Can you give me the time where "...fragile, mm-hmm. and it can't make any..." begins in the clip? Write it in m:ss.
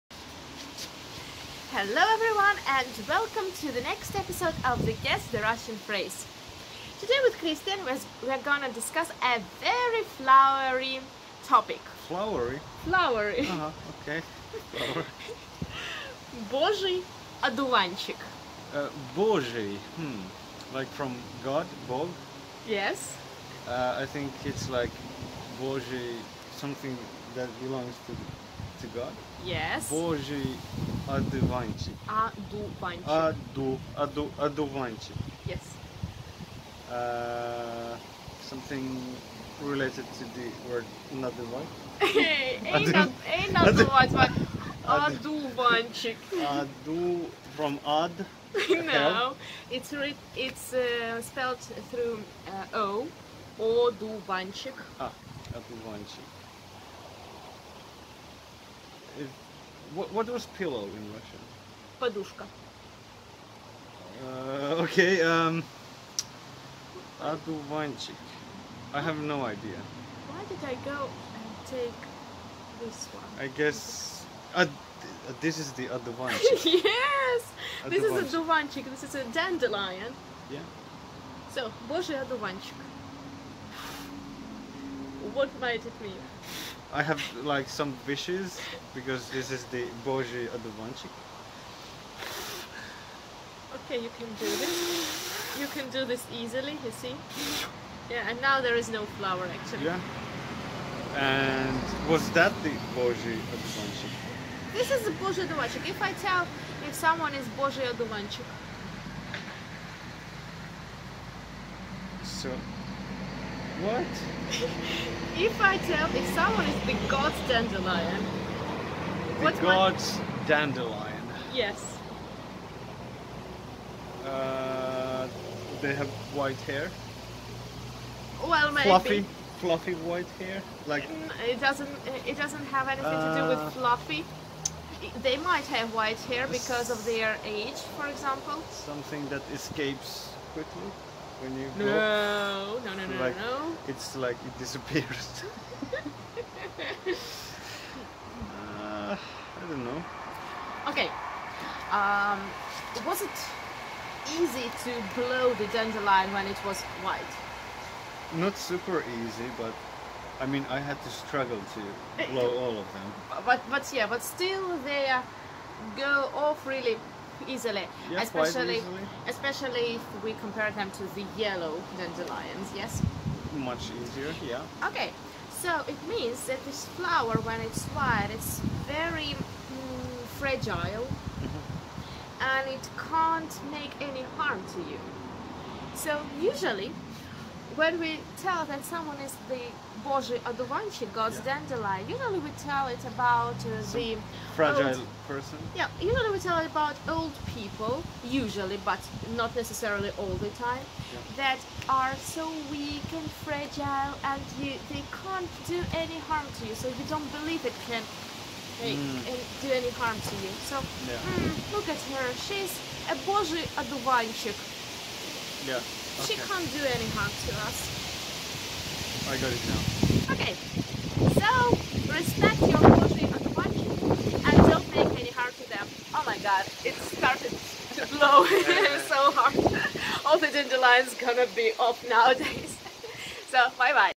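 3:00.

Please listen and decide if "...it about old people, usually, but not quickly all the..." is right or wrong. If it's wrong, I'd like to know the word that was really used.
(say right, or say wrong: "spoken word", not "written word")
wrong: "necessarily", not "quickly".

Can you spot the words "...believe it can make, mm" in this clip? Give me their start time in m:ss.
3:27.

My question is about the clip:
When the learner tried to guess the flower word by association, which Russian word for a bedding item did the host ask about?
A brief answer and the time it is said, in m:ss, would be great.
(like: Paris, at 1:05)
Подушка, at 1:01.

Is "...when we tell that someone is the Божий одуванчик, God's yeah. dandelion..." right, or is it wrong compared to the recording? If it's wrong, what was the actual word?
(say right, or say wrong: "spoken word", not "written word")
right.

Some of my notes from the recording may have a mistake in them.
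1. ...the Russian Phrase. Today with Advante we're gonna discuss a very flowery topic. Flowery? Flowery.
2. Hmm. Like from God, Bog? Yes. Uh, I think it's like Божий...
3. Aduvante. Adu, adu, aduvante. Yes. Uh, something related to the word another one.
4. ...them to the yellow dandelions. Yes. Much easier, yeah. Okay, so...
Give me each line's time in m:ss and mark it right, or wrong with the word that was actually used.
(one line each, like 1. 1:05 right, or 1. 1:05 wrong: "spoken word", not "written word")
1. 0:05 wrong: "Christian", not "Advante"
2. 0:19 right
3. 0:32 right
4. 2:50 right.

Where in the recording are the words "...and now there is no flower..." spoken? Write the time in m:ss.
1:38.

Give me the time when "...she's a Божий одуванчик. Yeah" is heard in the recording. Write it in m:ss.
3:32.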